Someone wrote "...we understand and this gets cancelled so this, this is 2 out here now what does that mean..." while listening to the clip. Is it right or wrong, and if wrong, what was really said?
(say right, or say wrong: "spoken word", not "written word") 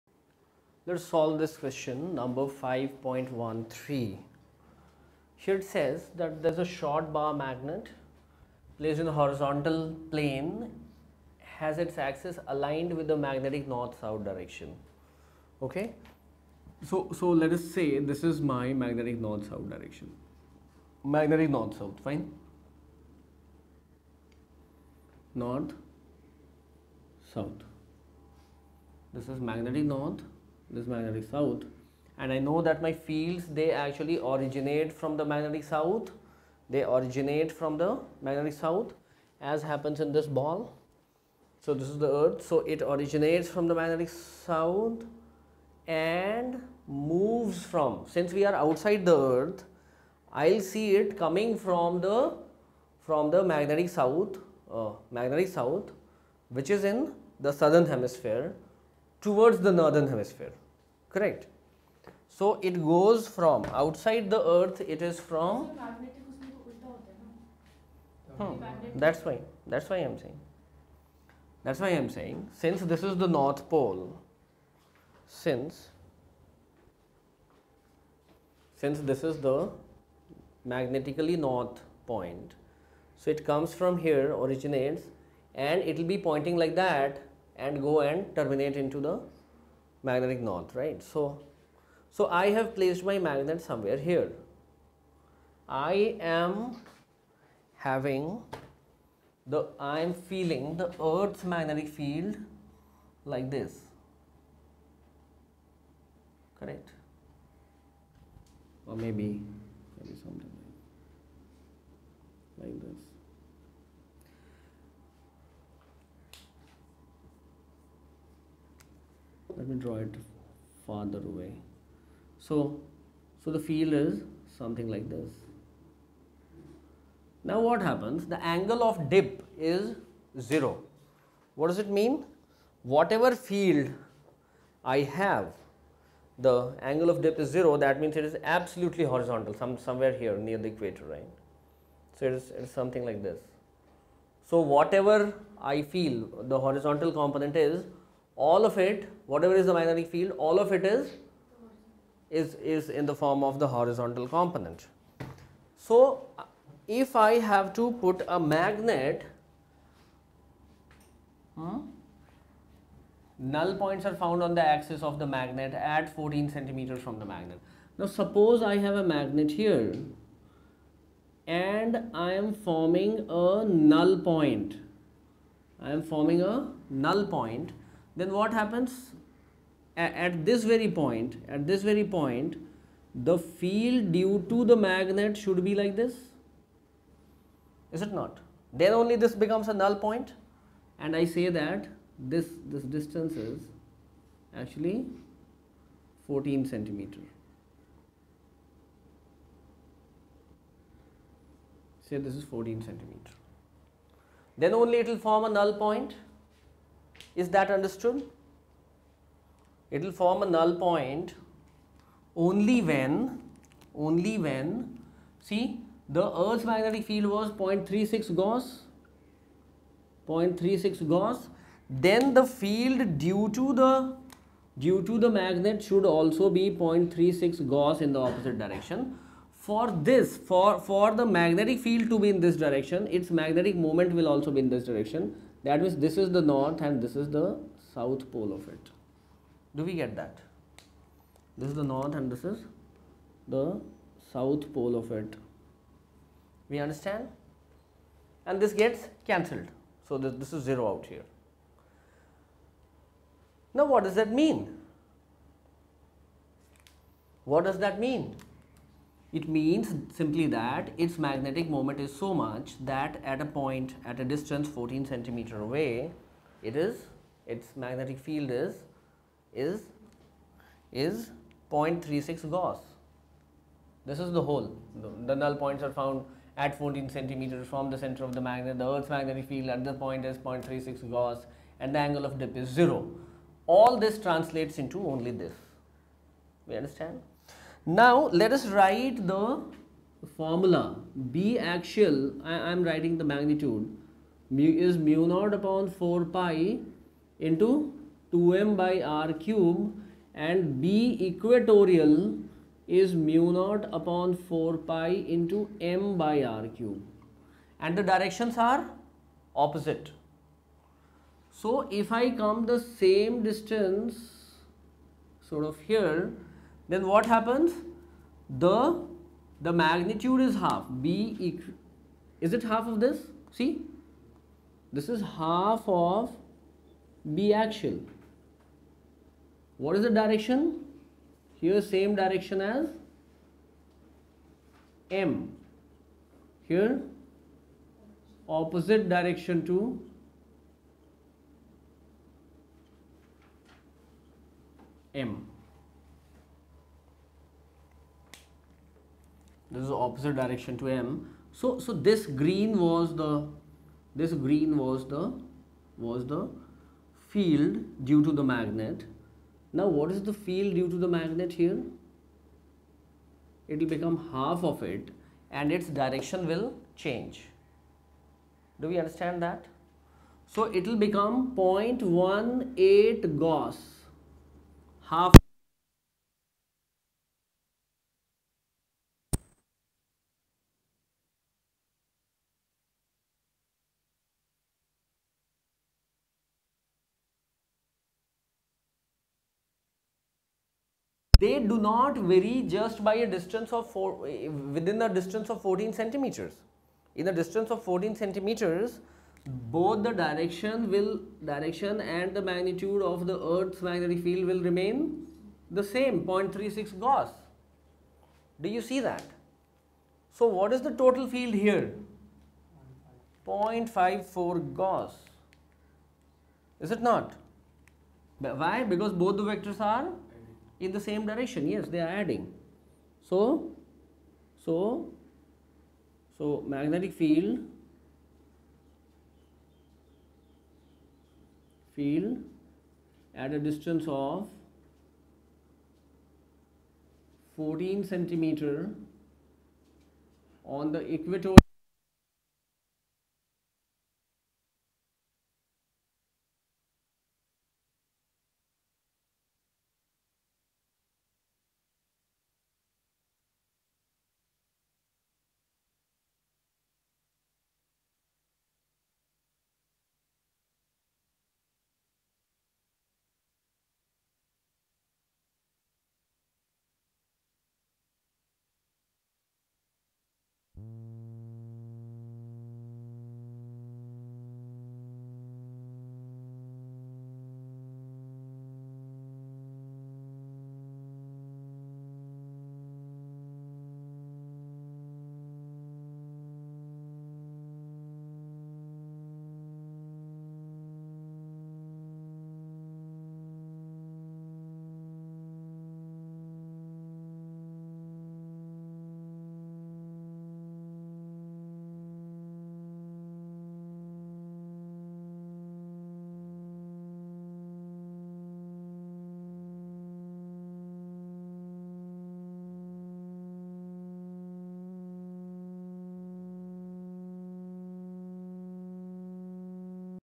wrong: "0", not "2".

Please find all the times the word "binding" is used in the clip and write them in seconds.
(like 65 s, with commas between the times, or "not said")
not said.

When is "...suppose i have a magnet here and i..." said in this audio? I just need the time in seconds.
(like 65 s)
168 s.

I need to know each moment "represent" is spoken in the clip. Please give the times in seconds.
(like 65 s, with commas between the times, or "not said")
not said.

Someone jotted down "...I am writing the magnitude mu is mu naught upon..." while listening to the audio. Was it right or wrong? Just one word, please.
right.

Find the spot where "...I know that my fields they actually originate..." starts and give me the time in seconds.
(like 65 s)
32 s.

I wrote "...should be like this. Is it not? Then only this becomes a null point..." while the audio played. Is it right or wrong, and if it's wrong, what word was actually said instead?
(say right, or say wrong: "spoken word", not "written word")
right.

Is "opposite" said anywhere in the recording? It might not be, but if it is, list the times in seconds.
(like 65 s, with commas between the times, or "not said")
228 s, 309 s, 338 s, 350 s.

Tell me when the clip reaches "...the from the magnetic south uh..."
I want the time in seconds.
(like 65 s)
51 s.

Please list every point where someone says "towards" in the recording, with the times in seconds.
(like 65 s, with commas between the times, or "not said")
59 s.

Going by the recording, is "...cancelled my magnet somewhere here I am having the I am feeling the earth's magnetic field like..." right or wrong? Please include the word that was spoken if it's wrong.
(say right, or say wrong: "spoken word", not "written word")
wrong: "placed", not "cancelled".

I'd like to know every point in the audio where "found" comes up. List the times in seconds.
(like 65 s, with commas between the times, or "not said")
164 s, 275 s.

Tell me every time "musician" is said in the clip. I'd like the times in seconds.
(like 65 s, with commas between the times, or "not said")
not said.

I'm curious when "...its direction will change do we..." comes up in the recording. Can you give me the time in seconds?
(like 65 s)
365 s.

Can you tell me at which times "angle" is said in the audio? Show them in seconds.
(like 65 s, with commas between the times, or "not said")
128 s, 136 s, 281 s.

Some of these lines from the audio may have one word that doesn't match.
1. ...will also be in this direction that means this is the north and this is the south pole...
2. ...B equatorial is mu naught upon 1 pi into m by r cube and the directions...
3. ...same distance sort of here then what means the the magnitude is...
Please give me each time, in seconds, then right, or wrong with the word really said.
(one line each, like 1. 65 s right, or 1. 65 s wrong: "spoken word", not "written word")
1. 234 s right
2. 300 s wrong: "4", not "1"
3. 312 s wrong: "happens", not "means".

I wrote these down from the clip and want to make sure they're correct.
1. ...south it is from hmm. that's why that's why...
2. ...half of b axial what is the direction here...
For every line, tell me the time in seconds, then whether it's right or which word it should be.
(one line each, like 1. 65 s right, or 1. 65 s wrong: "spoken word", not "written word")
1. 64 s wrong: "earth", not "south"
2. 325 s right.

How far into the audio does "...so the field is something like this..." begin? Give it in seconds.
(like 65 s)
123 s.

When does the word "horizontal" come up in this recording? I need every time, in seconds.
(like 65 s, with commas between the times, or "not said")
9 s, 139 s, 146 s, 153 s.